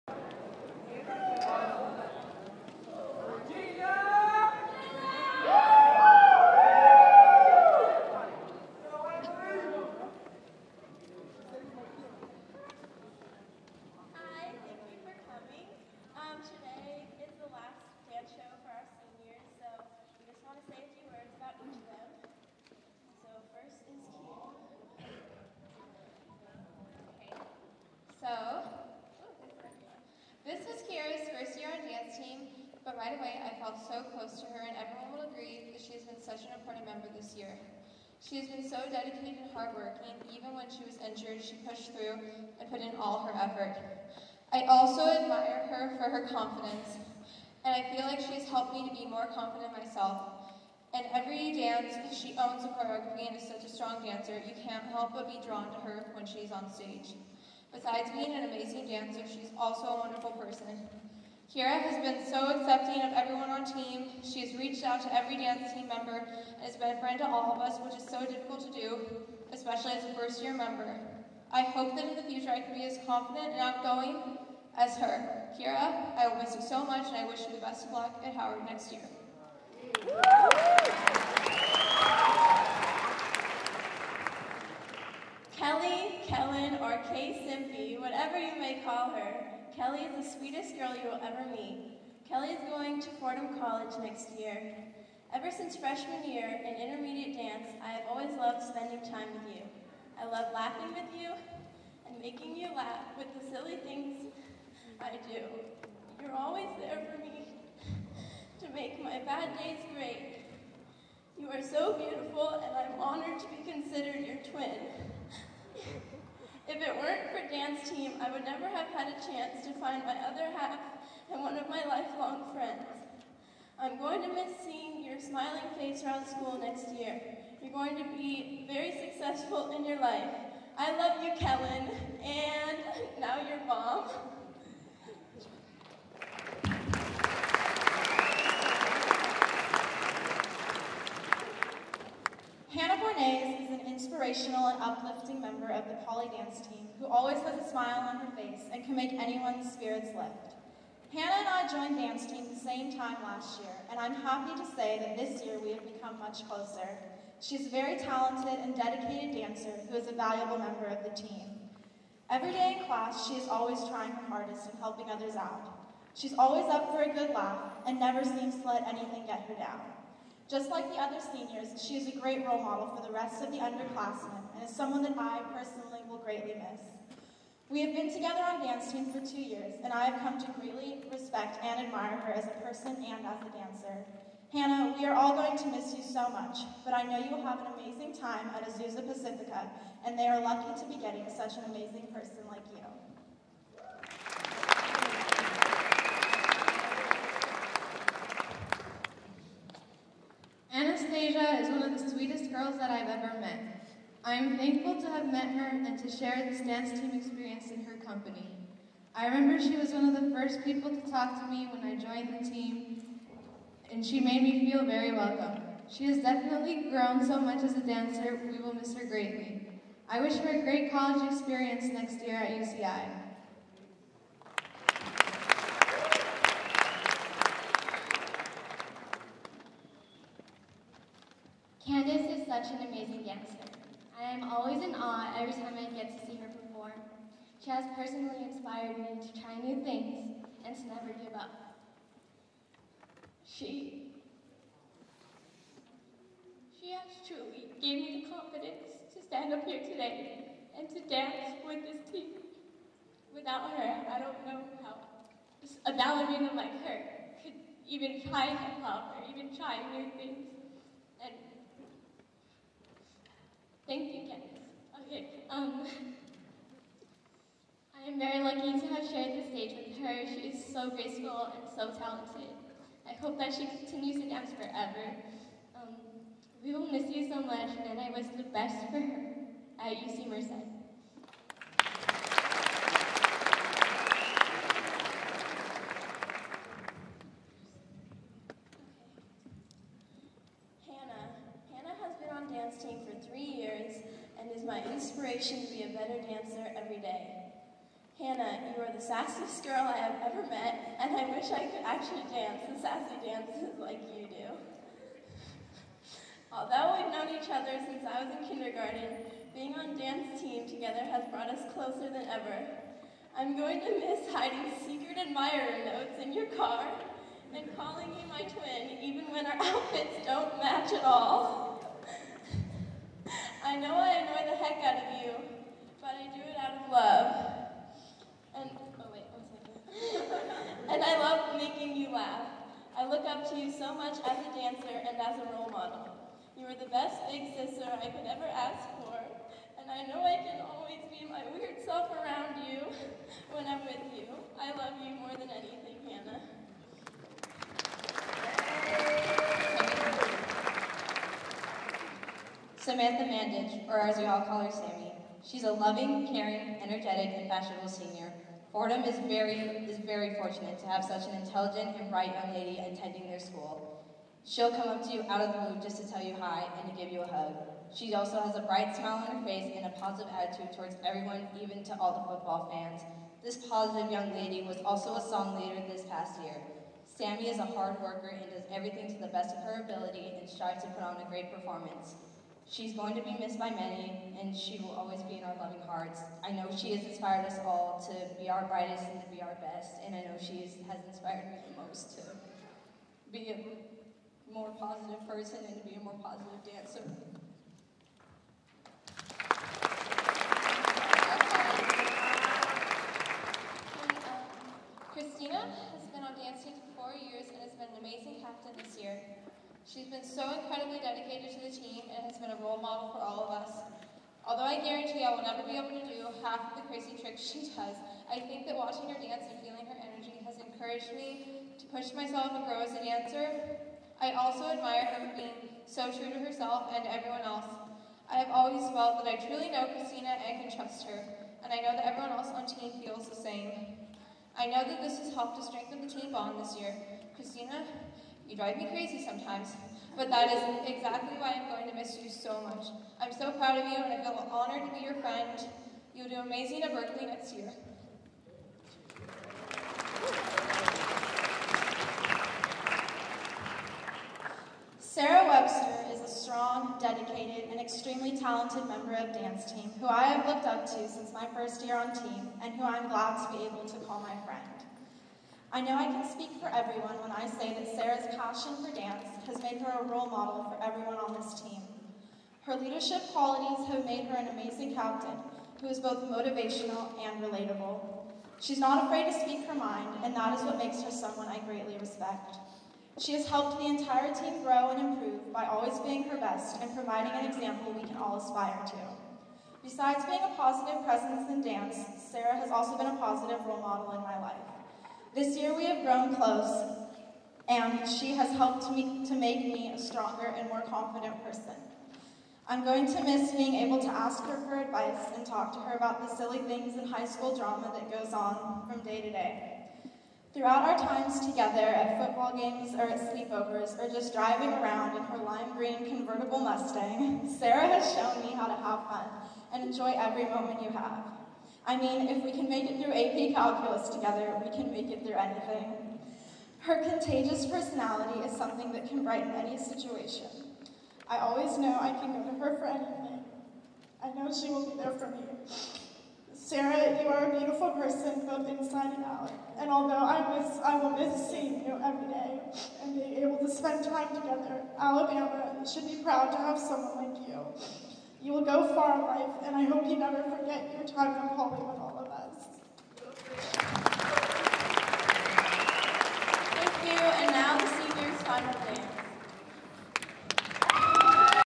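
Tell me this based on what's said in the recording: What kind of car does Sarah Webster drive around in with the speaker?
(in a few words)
lime green convertible Mustang.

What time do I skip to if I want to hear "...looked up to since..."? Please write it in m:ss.
7:40.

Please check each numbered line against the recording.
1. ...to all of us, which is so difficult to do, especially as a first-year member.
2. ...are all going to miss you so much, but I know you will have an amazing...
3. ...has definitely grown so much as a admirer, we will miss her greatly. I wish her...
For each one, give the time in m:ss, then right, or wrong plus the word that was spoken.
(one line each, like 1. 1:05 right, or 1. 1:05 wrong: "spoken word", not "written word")
1. 1:07 right
2. 3:05 right
3. 3:36 wrong: "dancer", not "admirer".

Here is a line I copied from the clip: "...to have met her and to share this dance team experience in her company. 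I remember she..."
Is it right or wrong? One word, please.
right.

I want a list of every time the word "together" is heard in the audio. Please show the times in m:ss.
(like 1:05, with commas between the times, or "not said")
2:58, 5:10, 8:31, 8:44, 9:04.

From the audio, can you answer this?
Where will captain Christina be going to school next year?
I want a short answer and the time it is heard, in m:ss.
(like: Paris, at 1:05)
Berkeley, at 7:26.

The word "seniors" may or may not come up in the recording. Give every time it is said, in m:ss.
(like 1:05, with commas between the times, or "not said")
2:51, 5:57, 9:17.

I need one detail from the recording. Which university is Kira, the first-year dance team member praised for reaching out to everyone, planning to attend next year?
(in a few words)
Howard.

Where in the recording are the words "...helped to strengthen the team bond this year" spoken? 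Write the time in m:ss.
7:15.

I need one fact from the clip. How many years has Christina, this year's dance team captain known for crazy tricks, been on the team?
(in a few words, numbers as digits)
4.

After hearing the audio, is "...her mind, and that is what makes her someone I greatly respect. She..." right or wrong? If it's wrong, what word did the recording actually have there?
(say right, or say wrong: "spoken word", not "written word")
right.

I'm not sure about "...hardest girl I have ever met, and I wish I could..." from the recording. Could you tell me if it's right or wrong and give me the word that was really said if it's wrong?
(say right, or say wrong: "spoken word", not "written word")
wrong: "sassiest", not "hardest".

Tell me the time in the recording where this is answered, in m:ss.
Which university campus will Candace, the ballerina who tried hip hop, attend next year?
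4:39.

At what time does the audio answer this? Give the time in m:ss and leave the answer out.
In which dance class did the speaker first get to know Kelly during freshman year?
1:36.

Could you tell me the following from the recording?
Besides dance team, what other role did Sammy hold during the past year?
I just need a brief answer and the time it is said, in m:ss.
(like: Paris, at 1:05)
song leader, at 6:15.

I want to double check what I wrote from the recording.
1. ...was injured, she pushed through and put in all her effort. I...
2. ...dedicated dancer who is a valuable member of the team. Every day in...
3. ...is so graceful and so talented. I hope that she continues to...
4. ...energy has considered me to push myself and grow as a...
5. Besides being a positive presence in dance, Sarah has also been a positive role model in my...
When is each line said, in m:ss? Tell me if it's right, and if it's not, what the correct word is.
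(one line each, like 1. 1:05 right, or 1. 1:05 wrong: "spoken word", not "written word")
1. 0:40 right
2. 2:38 right
3. 4:30 right
4. 7:00 wrong: "encouraged", not "considered"
5. 8:09 right.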